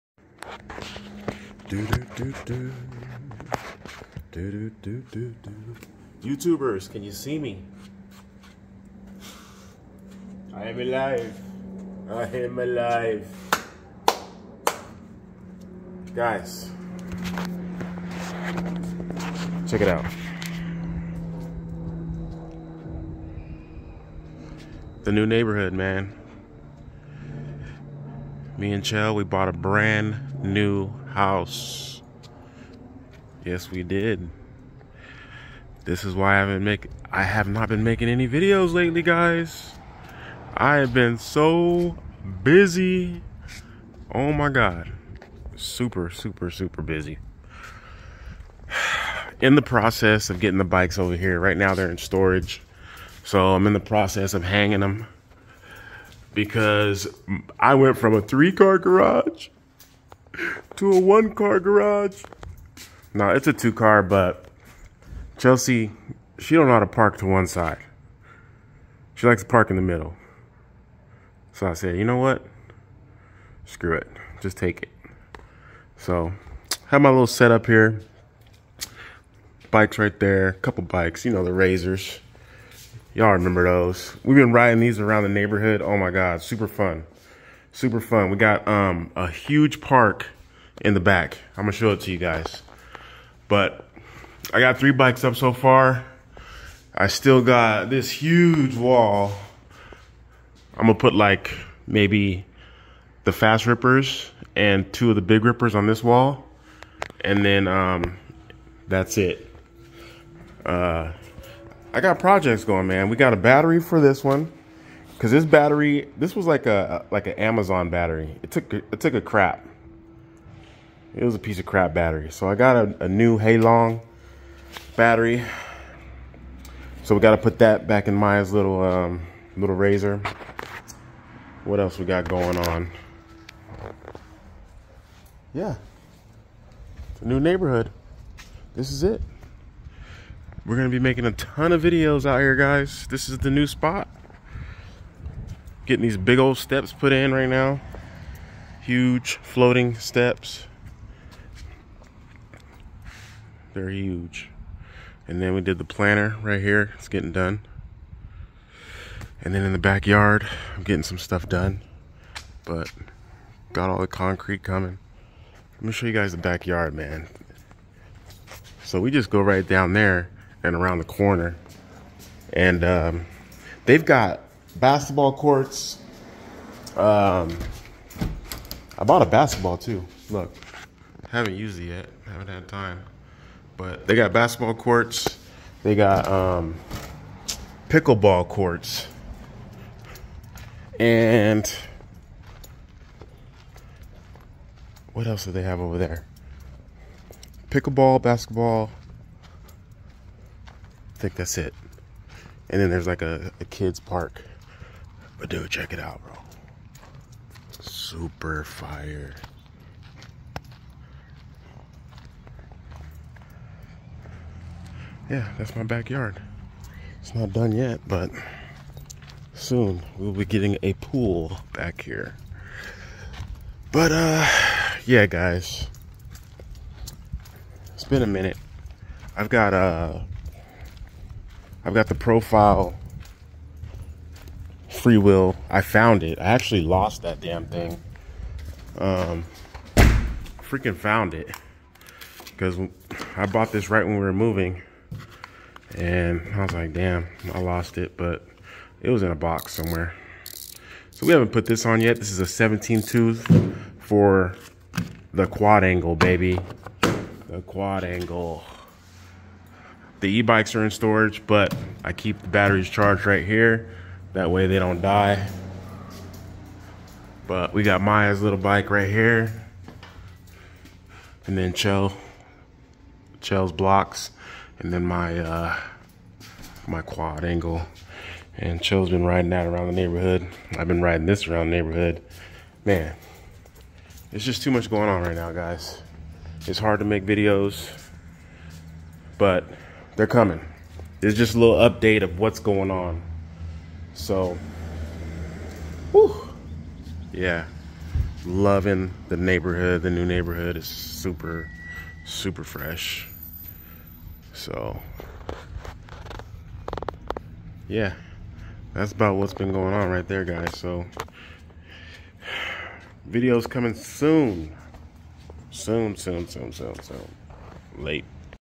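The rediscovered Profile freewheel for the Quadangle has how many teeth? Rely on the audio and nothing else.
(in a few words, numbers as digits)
17.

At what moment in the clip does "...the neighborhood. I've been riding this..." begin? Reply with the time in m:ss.
4:39.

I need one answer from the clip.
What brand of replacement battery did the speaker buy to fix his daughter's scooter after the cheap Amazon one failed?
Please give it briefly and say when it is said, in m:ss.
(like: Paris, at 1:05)
Hailong, at 2:03.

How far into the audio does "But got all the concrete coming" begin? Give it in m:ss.
2:42.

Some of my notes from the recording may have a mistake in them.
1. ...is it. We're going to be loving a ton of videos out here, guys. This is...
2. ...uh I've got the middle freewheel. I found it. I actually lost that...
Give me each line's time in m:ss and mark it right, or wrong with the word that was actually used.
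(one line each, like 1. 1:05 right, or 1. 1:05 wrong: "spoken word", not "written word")
1. 2:18 wrong: "making", not "loving"
2. 3:49 wrong: "profile", not "middle".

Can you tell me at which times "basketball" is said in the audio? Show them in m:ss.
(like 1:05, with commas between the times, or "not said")
2:54, 2:59, 3:04, 3:18.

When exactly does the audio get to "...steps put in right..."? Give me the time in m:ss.
2:26.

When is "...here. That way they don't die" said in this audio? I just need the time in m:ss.
4:23.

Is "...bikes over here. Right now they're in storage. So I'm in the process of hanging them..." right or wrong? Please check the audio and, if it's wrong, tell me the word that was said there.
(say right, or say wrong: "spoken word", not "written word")
right.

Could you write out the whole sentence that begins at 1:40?
I'm gonna put like maybe the fast rippers and two of the big rippers on this wall.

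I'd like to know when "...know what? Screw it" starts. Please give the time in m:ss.
1:12.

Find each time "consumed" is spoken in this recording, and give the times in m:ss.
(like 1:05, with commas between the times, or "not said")
not said.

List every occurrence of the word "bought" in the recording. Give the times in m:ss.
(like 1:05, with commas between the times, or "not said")
0:29, 2:59, 4:03.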